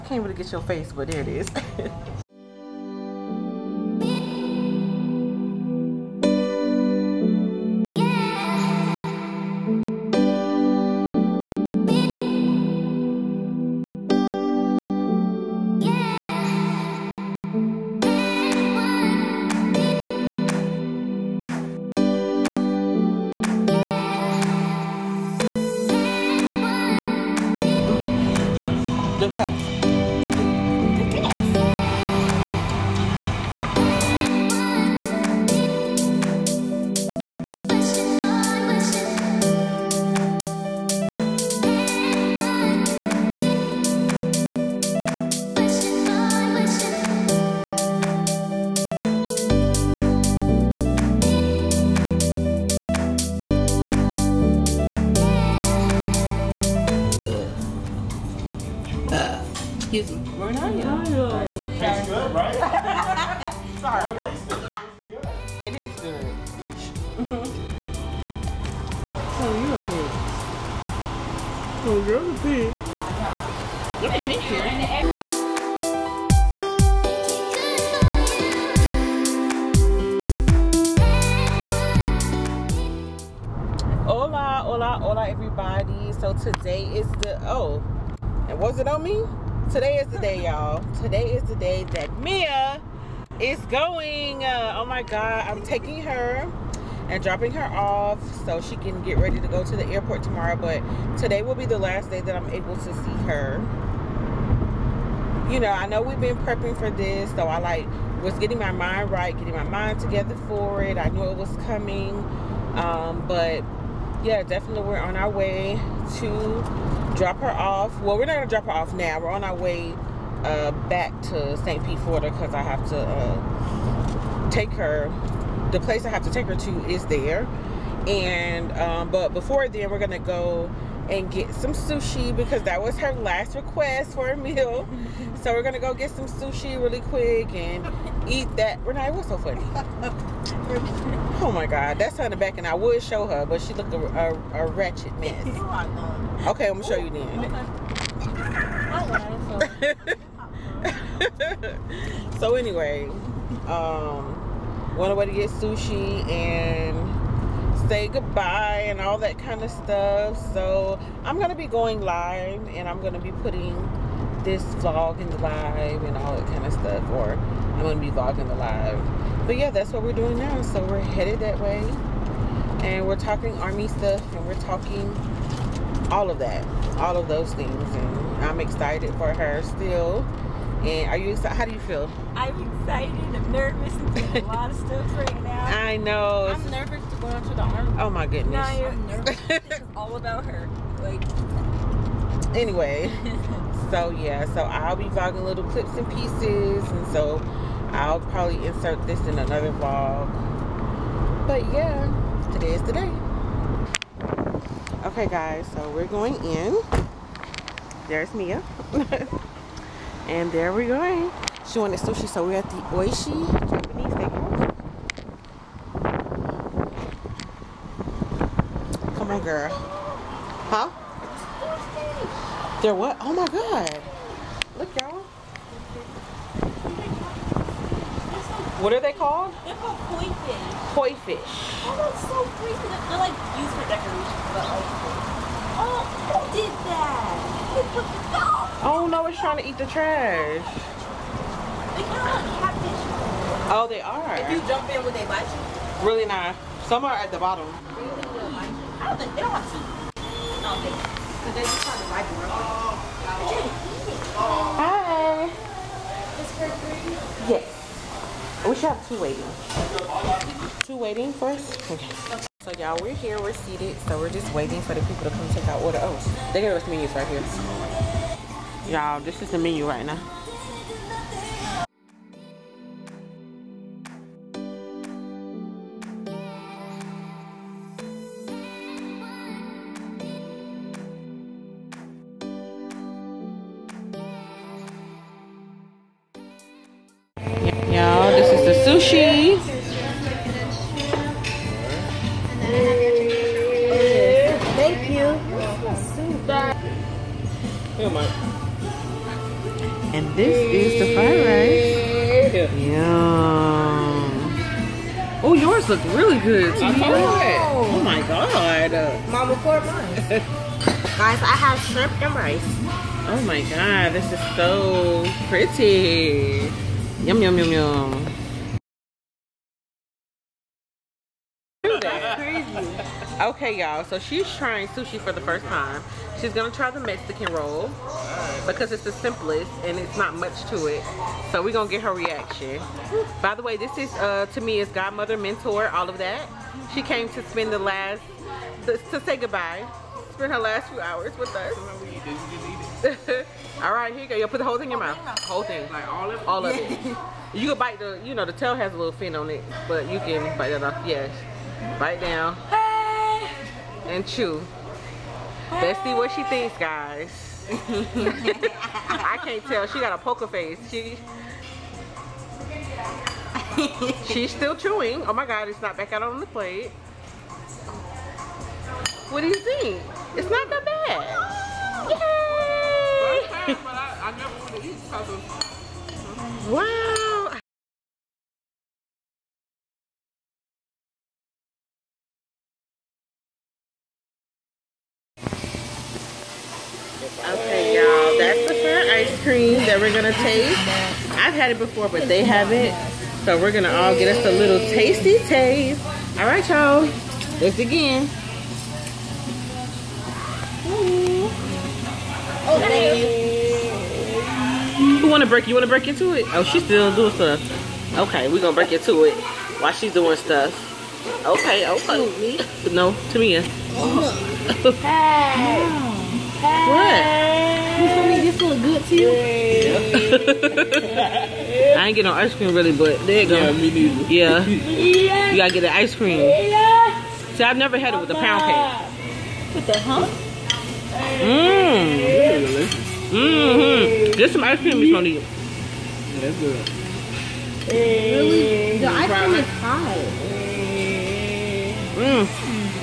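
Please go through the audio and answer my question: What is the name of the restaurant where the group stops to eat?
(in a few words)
Oishi.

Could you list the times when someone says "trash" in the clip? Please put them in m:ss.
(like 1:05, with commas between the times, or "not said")
3:59.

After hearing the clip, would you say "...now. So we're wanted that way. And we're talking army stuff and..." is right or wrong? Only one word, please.
wrong.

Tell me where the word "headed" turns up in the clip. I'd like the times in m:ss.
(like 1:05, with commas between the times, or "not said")
2:51.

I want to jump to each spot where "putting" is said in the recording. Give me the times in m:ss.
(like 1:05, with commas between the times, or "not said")
2:43.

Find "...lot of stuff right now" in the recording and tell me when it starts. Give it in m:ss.
3:04.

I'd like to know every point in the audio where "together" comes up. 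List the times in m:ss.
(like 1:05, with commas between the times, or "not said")
1:49.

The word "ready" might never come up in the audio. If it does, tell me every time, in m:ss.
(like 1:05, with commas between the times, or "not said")
1:39.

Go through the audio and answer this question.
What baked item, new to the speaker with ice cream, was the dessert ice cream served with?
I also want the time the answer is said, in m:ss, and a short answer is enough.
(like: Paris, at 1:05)
Pound cake, at 7:08.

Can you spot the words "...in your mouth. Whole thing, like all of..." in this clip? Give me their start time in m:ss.
5:44.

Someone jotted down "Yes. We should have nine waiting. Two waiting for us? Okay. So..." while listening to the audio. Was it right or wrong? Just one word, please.
wrong.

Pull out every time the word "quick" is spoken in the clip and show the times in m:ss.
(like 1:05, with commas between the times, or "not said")
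2:17.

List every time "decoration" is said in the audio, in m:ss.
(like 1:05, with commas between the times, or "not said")
3:53.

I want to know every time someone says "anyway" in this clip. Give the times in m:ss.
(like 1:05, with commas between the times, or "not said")
2:32, 3:12.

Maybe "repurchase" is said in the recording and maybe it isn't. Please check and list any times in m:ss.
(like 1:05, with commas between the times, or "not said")
not said.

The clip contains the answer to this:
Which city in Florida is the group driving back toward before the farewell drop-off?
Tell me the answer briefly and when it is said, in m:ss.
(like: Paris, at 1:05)
St. Pete, at 2:01.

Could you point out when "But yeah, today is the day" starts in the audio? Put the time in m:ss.
3:21.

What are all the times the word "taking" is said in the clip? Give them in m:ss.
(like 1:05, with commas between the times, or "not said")
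1:35.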